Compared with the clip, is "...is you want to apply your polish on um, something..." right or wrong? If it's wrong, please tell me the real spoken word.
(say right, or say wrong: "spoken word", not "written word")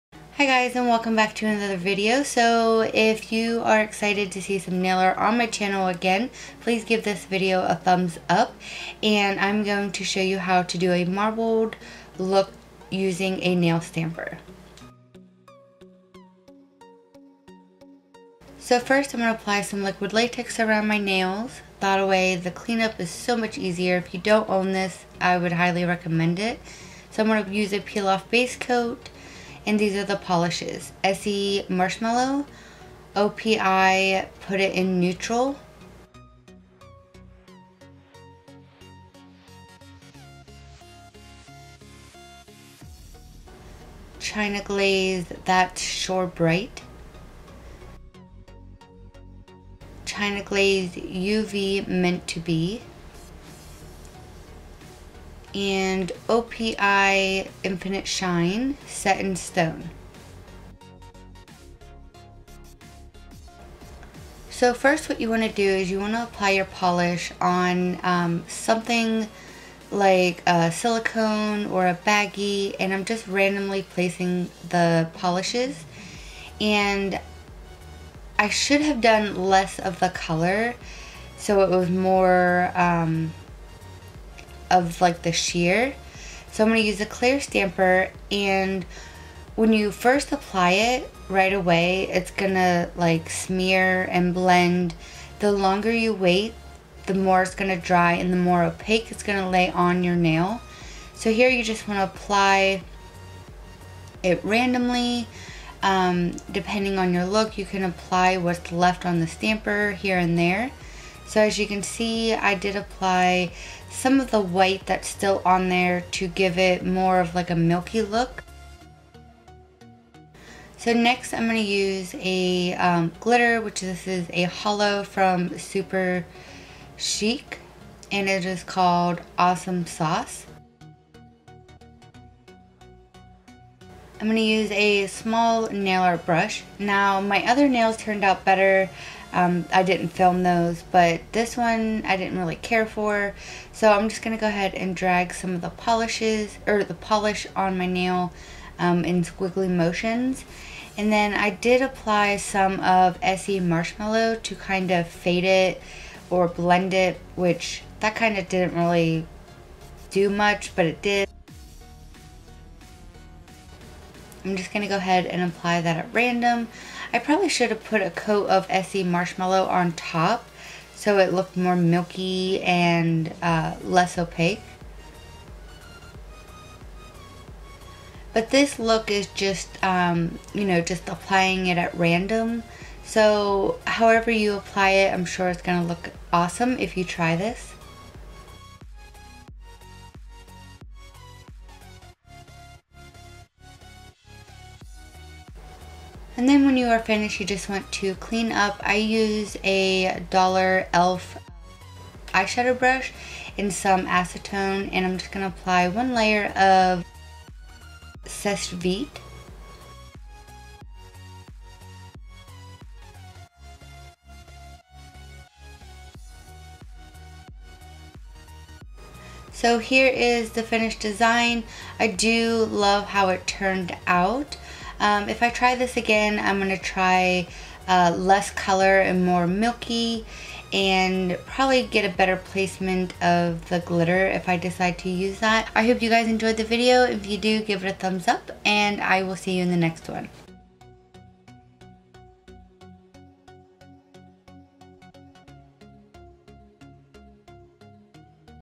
right.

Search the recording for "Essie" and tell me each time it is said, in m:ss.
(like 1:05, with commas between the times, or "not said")
0:31, 2:33, 2:48.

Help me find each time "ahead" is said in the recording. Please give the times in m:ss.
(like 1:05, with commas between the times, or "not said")
2:24, 2:44.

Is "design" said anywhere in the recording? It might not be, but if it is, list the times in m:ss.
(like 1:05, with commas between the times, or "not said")
3:41.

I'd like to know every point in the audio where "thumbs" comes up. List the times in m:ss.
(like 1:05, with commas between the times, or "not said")
0:07, 3:57.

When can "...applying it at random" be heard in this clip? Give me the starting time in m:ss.
3:01.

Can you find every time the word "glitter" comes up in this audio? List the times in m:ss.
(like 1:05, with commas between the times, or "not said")
2:03, 3:53.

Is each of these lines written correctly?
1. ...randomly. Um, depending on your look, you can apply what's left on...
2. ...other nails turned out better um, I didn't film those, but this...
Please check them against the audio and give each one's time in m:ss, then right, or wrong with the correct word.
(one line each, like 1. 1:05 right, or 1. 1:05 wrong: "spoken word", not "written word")
1. 1:44 right
2. 2:17 right.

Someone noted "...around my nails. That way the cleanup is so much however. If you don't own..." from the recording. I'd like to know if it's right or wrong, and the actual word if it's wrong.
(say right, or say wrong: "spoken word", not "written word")
wrong: "easier", not "however".